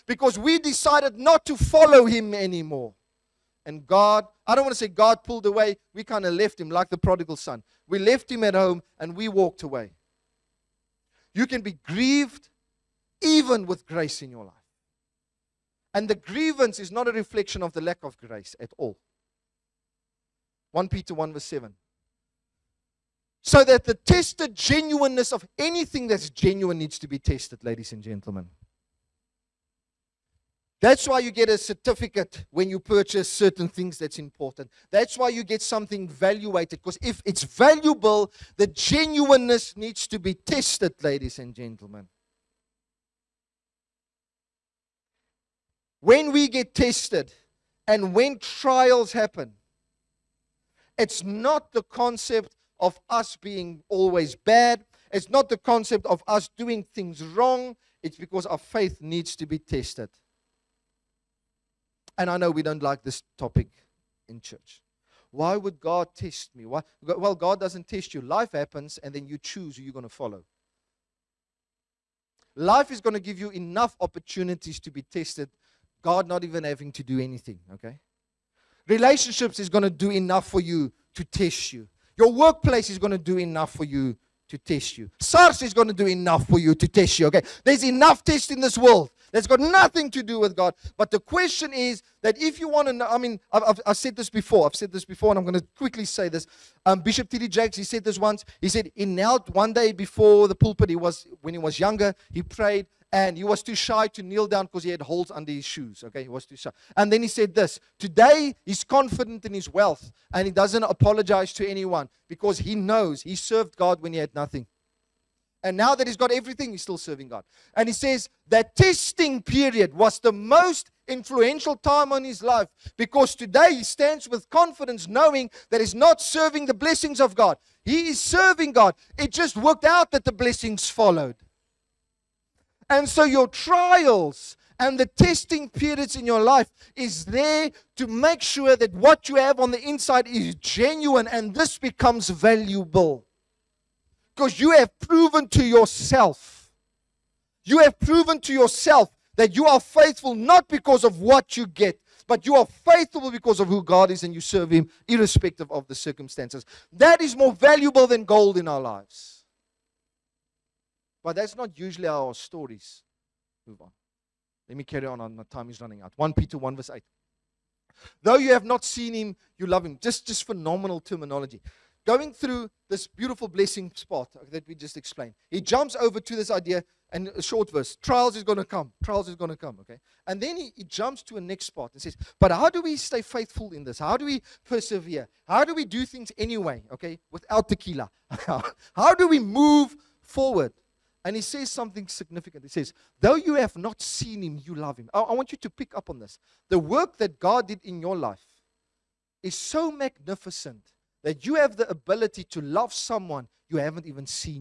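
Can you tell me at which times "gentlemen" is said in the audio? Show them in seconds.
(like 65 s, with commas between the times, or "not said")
28 s, 41 s.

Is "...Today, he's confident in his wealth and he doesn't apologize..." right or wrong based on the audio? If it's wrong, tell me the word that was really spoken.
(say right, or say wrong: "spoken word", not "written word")
right.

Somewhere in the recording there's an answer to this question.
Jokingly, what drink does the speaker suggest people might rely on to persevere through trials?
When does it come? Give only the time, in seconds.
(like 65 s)
187 s.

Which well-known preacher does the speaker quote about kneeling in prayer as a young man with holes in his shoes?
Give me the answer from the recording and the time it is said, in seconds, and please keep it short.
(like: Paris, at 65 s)
Bishop T.D. Jakes, at 97 s.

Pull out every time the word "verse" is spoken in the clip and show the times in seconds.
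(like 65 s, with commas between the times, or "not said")
21 s, 166 s, 177 s.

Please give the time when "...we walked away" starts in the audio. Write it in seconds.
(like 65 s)
9 s.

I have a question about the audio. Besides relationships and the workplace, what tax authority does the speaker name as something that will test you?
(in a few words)
SARS.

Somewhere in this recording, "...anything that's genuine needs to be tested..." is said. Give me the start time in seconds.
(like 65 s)
25 s.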